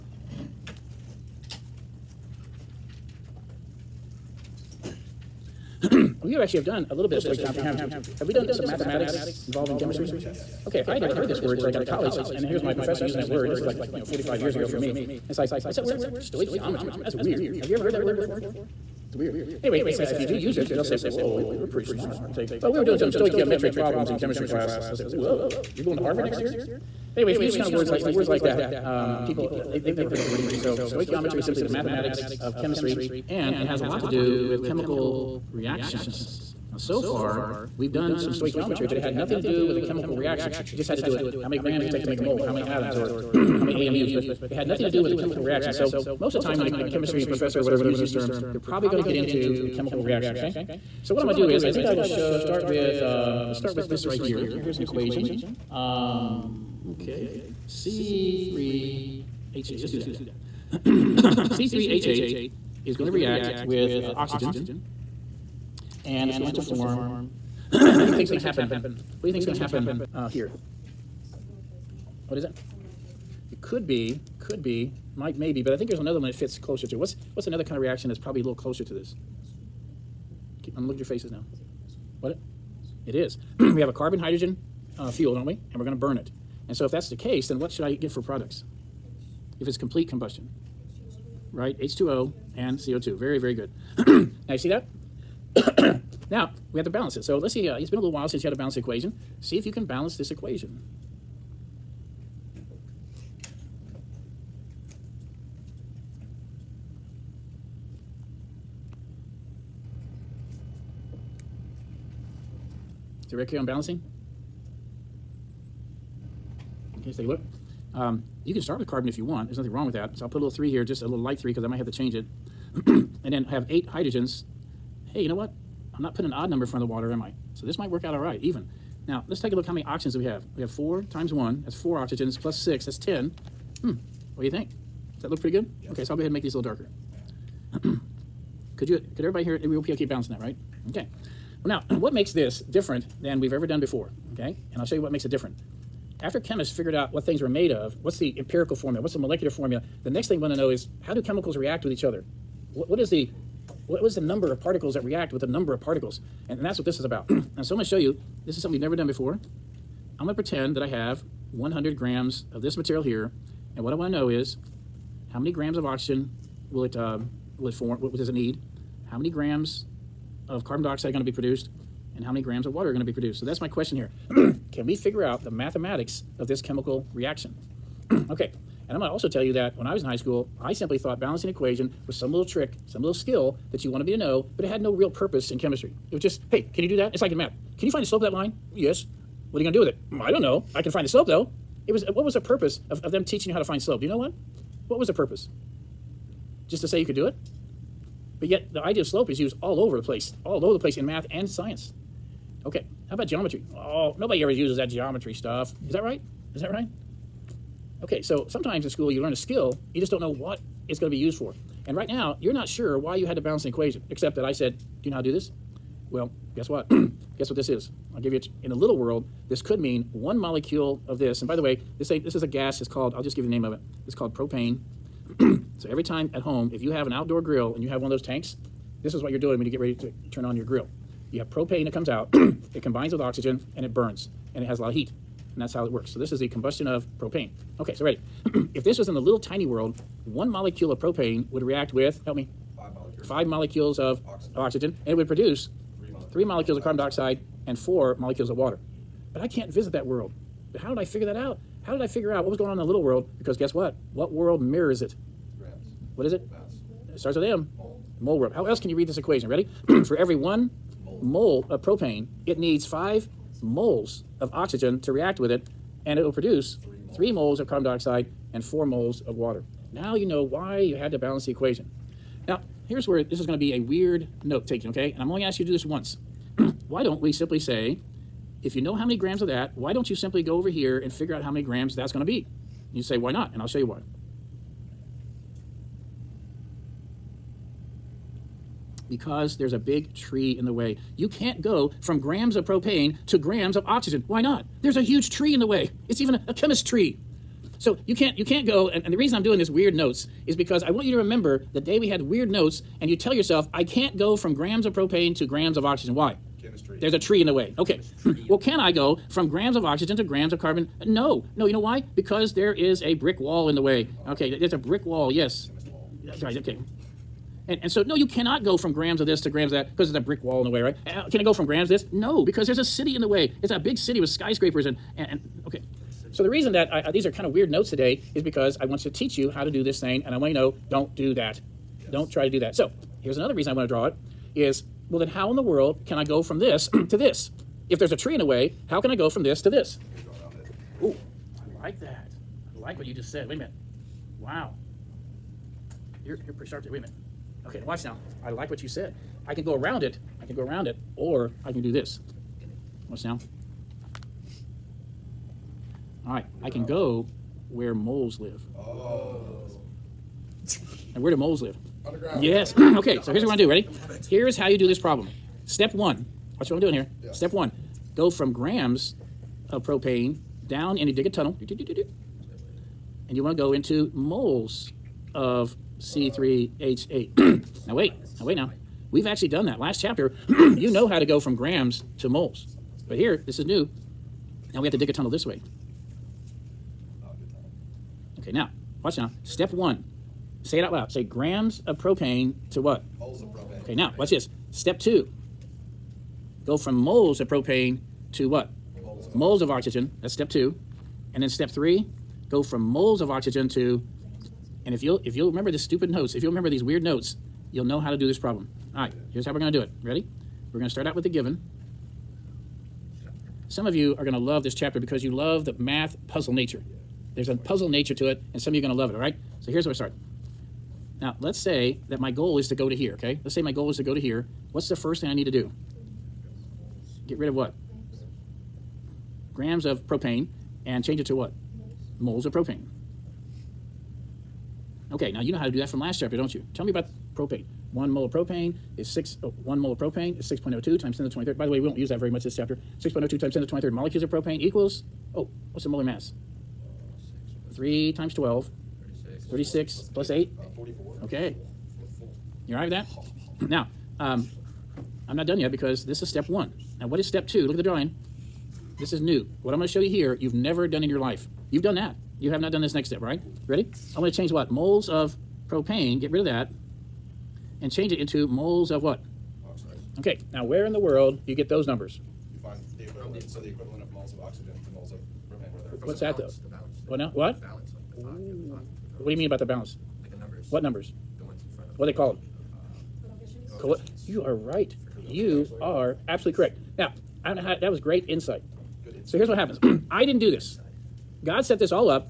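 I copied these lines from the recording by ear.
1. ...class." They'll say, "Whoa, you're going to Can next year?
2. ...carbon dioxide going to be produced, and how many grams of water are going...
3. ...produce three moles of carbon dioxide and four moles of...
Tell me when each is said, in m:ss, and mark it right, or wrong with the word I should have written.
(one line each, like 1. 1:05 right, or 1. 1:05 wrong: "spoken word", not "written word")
1. 0:24 wrong: "Harvard", not "Can"
2. 2:50 right
3. 4:26 right.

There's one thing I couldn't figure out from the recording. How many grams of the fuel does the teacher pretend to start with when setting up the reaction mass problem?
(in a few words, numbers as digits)
100 grams.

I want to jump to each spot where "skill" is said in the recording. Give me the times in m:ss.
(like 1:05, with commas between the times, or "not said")
3:03, 3:29.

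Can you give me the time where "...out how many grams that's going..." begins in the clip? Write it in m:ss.
4:41.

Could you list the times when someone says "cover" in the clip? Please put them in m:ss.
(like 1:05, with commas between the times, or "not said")
not said.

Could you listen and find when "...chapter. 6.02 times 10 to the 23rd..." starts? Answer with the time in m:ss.
7:22.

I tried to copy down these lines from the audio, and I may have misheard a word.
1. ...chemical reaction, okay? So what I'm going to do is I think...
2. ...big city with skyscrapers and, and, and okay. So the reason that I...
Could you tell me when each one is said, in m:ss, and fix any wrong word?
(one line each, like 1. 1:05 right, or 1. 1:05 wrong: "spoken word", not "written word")
1. 0:49 right
2. 5:23 right.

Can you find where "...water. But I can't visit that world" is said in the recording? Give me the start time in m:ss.
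4:08.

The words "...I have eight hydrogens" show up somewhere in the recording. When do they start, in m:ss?
2:03.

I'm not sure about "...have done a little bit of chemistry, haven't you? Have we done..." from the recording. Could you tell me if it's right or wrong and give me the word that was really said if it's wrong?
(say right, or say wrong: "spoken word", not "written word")
wrong: "stoichiometry", not "chemistry".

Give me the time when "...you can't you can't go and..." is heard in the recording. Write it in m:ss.
4:58.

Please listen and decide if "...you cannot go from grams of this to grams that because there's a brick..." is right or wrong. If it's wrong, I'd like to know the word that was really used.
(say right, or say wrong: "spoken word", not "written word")
right.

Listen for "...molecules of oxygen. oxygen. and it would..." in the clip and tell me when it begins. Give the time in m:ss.
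4:03.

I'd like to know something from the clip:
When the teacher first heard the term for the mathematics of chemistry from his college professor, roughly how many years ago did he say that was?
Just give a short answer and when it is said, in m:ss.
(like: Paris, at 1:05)
45 years, at 0:14.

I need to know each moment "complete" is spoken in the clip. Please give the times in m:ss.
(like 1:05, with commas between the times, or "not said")
1:29.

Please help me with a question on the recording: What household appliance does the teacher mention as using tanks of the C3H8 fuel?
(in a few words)
Outdoor grill.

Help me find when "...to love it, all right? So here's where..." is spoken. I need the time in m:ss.
6:58.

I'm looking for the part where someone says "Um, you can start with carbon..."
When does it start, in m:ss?
1:57.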